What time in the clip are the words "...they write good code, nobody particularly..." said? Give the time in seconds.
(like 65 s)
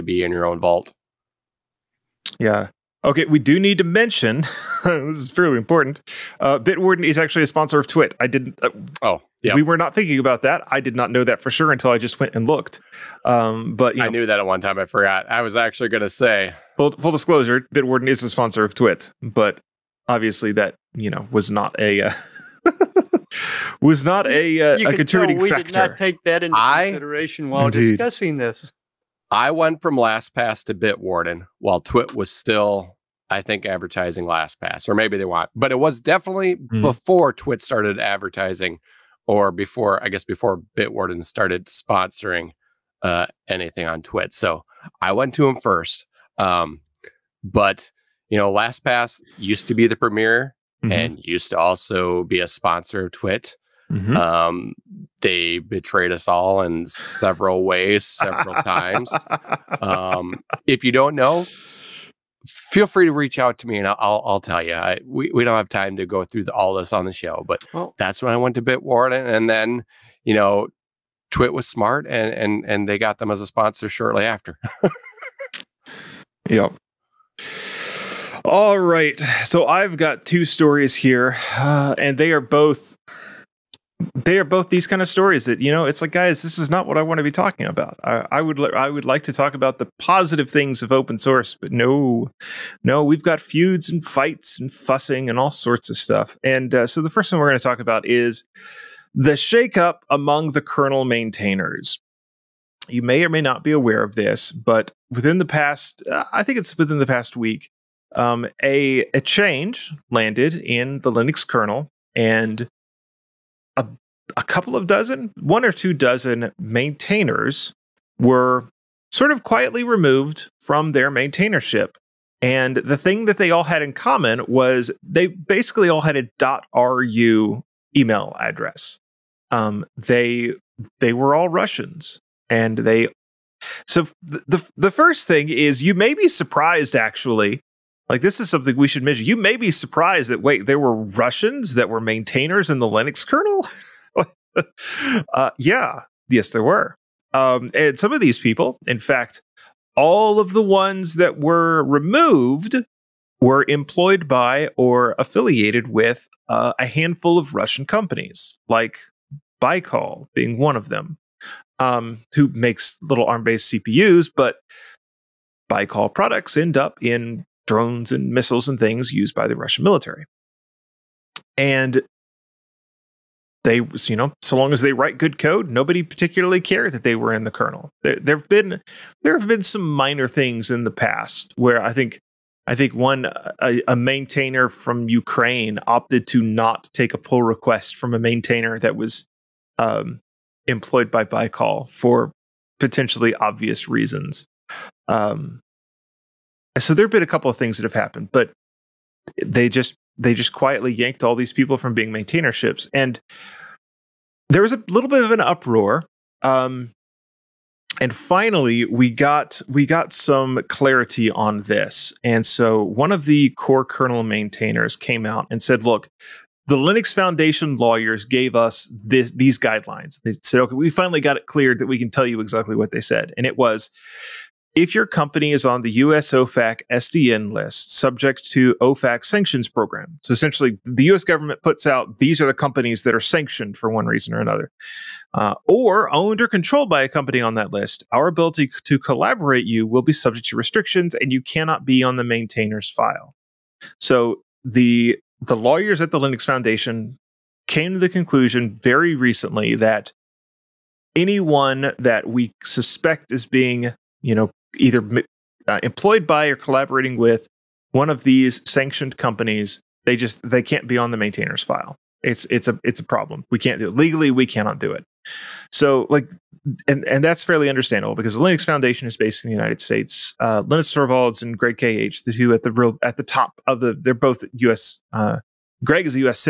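174 s.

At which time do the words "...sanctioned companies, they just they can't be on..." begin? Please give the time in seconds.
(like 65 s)
258 s.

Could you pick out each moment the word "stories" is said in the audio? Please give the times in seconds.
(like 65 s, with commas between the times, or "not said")
80 s, 85 s.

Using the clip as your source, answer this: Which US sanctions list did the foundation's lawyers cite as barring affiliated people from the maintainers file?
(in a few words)
OFAC SDN list.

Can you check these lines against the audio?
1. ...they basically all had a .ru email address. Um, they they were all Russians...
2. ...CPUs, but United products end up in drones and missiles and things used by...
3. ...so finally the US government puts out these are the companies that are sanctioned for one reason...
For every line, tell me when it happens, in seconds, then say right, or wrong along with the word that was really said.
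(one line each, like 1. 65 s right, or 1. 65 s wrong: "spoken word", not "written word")
1. 125 s right
2. 163 s wrong: "Baikal", not "United"
3. 230 s wrong: "essentially", not "finally".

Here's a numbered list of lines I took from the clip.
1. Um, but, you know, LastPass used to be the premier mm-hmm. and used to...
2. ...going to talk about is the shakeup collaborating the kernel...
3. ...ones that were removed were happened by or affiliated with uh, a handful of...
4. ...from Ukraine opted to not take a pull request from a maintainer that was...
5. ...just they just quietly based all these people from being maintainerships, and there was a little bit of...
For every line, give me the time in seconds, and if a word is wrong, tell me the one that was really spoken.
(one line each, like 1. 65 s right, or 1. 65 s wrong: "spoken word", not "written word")
1. 46 s right
2. 97 s wrong: "among", not "collaborating"
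3. 150 s wrong: "employed", not "happened"
4. 184 s right
5. 199 s wrong: "yanked", not "based".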